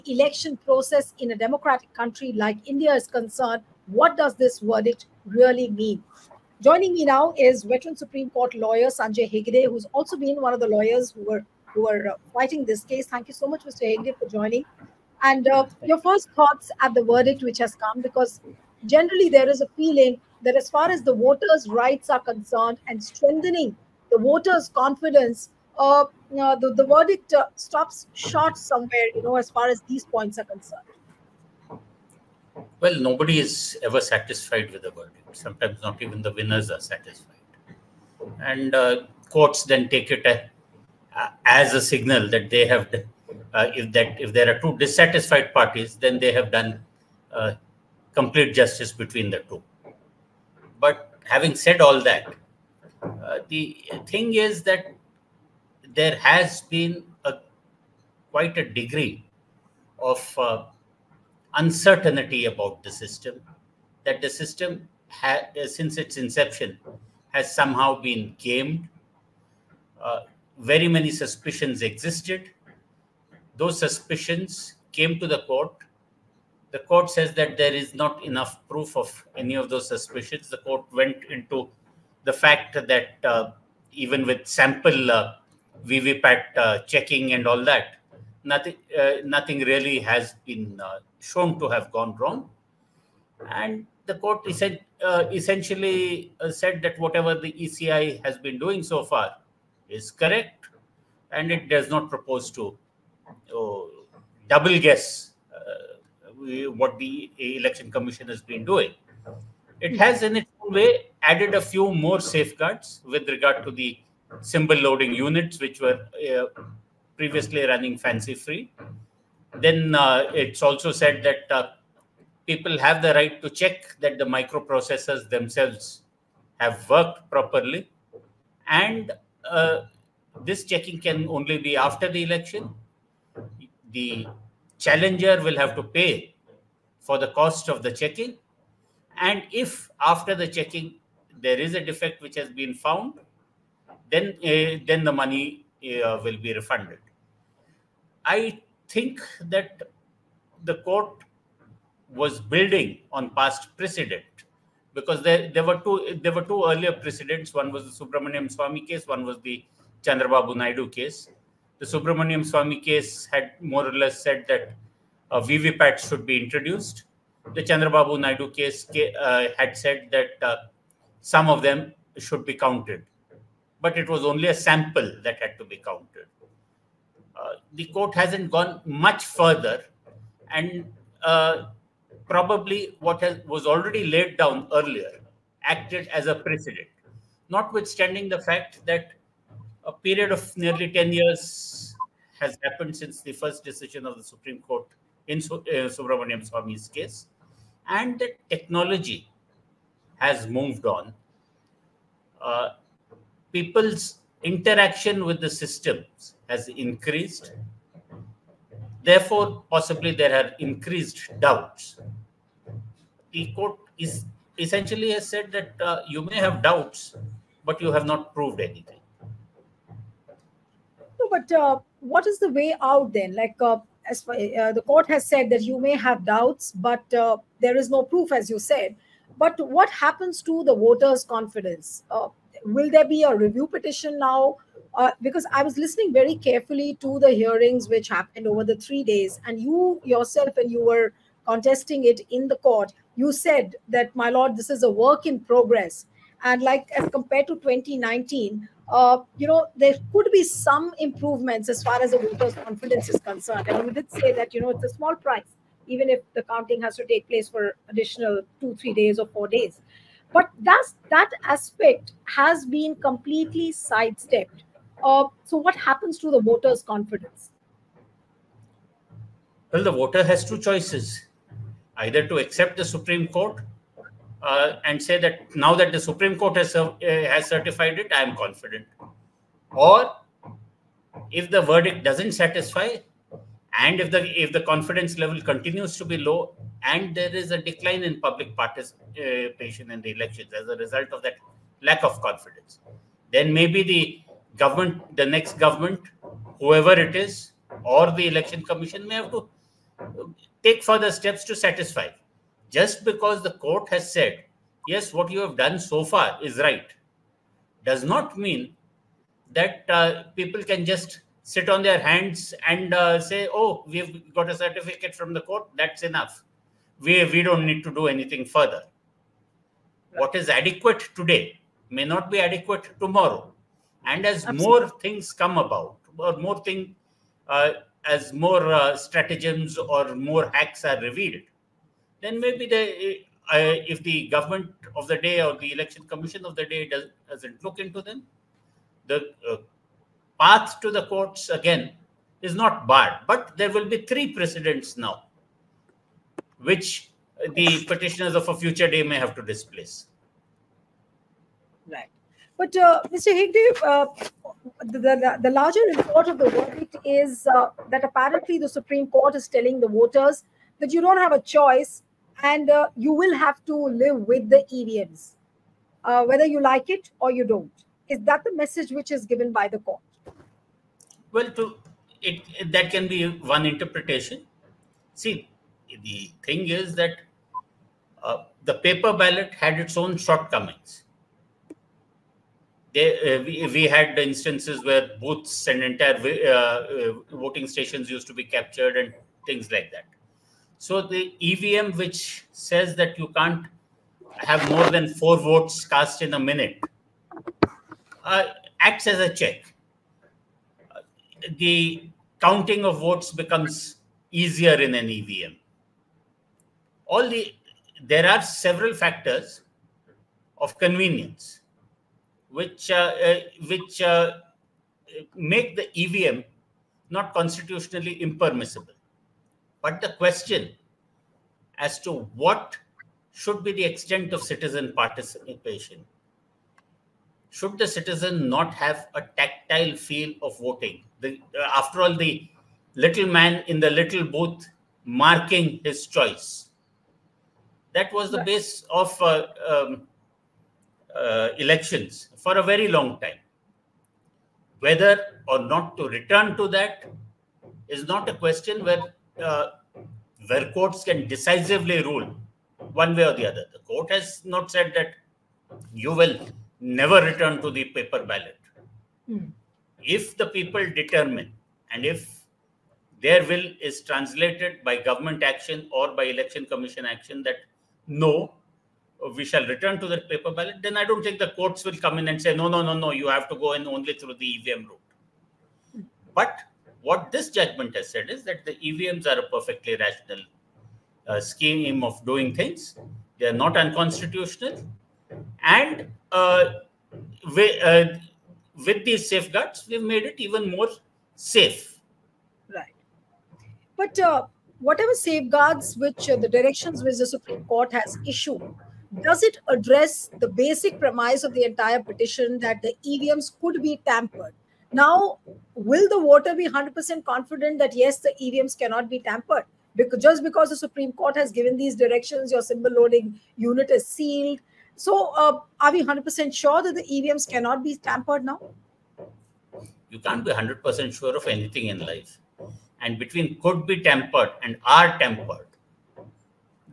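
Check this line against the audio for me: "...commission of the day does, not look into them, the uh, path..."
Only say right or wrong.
right.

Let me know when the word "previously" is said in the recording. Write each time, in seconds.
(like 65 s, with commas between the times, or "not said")
117 s.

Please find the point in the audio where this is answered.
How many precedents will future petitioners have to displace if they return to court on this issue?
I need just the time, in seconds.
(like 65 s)
344 s.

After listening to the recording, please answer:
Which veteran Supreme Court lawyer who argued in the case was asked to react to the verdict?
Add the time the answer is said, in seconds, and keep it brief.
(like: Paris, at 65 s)
Sanjay Hegde, at 8 s.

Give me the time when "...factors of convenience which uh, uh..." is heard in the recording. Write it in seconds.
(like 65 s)
408 s.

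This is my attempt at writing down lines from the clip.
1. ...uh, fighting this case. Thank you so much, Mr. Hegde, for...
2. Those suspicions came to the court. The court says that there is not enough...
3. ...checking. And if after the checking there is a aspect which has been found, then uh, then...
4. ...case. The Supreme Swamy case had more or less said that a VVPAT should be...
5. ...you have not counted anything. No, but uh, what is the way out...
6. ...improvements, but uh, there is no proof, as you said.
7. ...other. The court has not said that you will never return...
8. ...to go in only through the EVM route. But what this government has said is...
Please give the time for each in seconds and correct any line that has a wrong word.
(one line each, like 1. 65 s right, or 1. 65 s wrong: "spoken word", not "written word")
1. 12 s right
2. 73 s right
3. 137 s wrong: "defect", not "aspect"
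4. 160 s wrong: "Subramanian", not "Supreme"
5. 217 s wrong: "proved", not "counted"
6. 226 s wrong: "doubts", not "improvements"
7. 453 s right
8. 473 s wrong: "judgment", not "government".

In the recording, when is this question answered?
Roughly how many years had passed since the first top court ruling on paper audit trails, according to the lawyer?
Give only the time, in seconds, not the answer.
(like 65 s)
190 s.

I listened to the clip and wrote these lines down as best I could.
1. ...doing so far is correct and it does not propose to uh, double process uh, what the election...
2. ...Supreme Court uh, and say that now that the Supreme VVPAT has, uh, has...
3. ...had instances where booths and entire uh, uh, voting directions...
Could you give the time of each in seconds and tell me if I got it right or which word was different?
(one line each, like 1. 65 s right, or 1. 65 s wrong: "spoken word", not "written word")
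1. 98 s wrong: "guess", not "process"
2. 272 s wrong: "Court", not "VVPAT"
3. 383 s wrong: "stations", not "directions".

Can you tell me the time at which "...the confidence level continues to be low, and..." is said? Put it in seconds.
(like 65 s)
284 s.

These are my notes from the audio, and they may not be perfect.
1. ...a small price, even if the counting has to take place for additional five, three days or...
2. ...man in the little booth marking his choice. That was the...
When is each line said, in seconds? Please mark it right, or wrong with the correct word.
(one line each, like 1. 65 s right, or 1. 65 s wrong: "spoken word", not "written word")
1. 254 s wrong: "two", not "five"
2. 433 s right.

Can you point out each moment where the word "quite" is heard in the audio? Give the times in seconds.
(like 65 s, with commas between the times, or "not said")
58 s.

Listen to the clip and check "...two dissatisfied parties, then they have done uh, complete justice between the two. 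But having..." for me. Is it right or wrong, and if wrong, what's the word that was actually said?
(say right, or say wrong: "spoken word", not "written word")
right.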